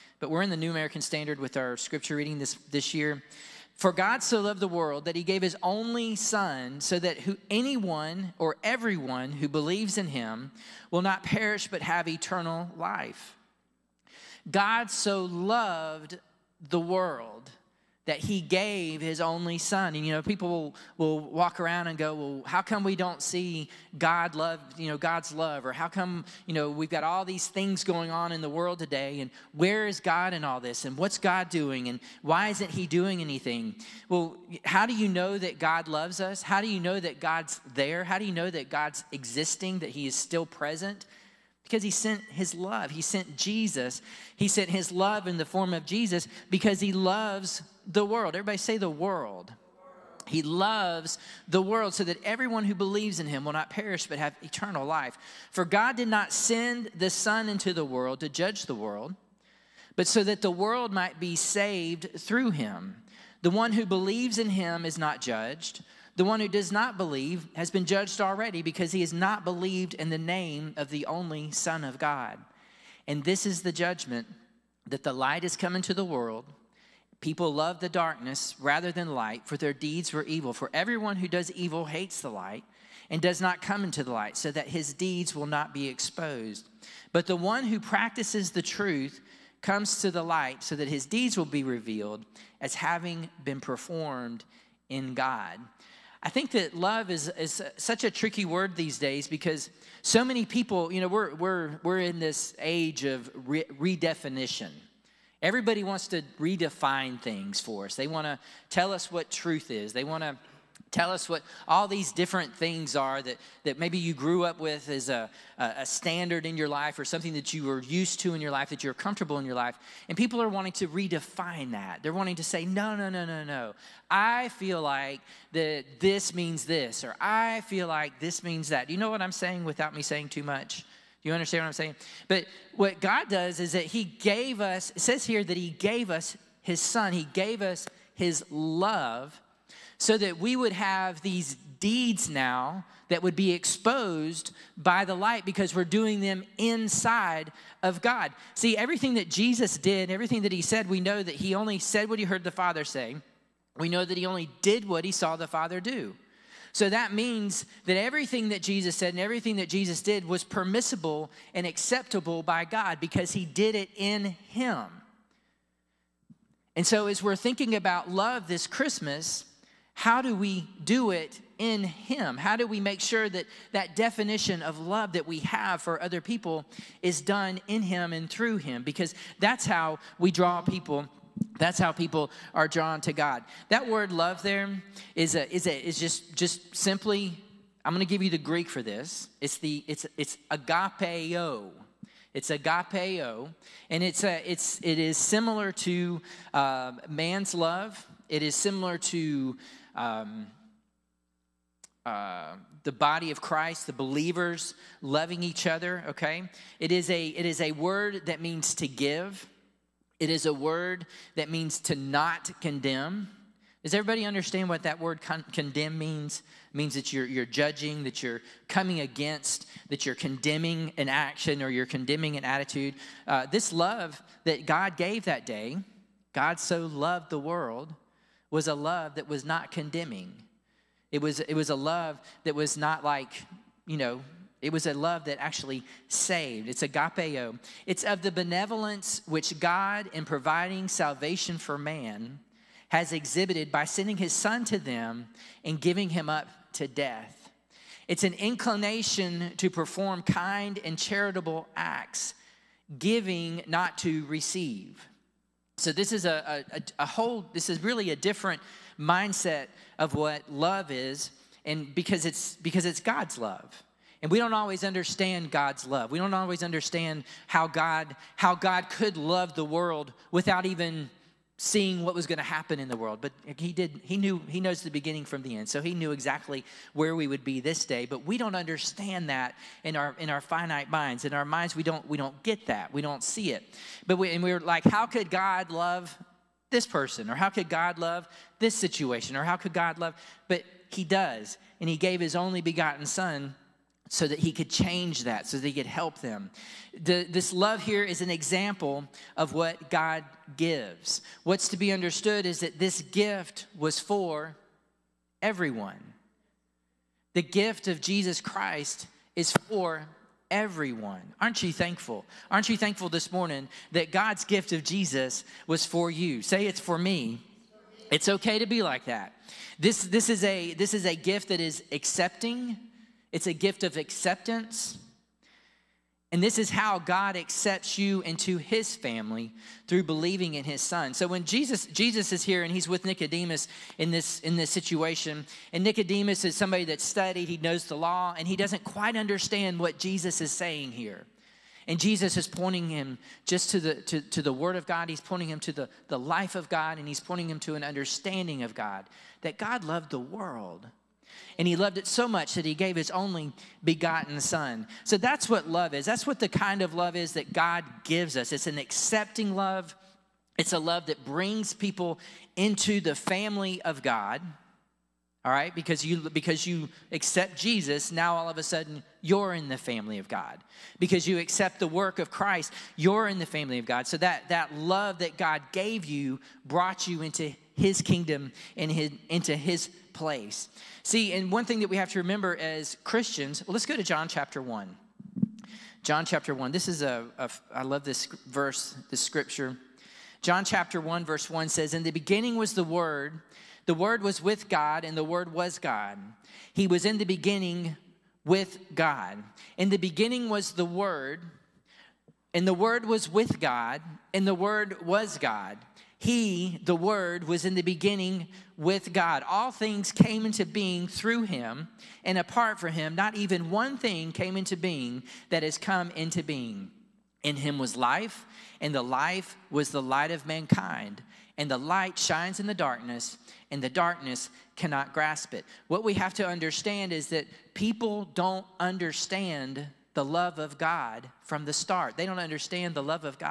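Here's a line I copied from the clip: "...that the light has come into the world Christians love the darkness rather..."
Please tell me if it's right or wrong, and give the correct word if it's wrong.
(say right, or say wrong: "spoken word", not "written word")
wrong: "People", not "Christians".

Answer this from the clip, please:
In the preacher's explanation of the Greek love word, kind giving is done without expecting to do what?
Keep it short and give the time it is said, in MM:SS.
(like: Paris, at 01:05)
to receive, at 04:12.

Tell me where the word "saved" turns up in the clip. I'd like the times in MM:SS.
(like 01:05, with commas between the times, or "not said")
01:01, 03:56.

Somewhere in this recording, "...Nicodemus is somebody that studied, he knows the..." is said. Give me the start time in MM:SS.
05:35.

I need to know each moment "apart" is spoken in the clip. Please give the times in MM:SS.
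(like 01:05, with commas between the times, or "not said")
06:52.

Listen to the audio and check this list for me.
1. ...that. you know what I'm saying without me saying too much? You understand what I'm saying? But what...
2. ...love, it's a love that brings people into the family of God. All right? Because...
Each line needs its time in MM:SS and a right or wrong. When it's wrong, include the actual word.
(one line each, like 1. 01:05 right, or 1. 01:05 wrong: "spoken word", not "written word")
1. 02:08 right
2. 05:59 right.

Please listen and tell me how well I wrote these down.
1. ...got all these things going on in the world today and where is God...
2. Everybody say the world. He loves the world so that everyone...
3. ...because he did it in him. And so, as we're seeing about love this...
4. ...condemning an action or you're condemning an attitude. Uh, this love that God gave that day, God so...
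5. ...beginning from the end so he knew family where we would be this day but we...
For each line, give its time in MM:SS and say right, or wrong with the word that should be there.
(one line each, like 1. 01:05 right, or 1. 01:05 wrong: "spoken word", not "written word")
1. 00:26 right
2. 00:48 right
3. 02:42 wrong: "thinking", not "seeing"
4. 03:40 right
5. 04:34 wrong: "exactly", not "family".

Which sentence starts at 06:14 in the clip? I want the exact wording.
So that that love that God gave you brought you into his kingdom and his, into his place.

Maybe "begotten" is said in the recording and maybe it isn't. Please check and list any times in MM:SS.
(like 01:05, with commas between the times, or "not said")
04:52, 05:53.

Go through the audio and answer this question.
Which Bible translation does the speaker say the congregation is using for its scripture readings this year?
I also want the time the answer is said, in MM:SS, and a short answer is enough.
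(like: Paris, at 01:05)
New American Standard, at 00:00.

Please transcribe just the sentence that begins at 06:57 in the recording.
In him was life, and the life was the light of mankind.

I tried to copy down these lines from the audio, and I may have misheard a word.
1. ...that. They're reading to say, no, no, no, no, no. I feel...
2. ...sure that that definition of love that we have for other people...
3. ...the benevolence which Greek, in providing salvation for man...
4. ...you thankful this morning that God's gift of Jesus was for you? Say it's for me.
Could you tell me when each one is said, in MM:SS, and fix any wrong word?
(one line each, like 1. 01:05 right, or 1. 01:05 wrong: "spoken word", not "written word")
1. 02:01 wrong: "wanting", not "reading"
2. 02:52 right
3. 03:58 wrong: "God", not "Greek"
4. 05:12 right.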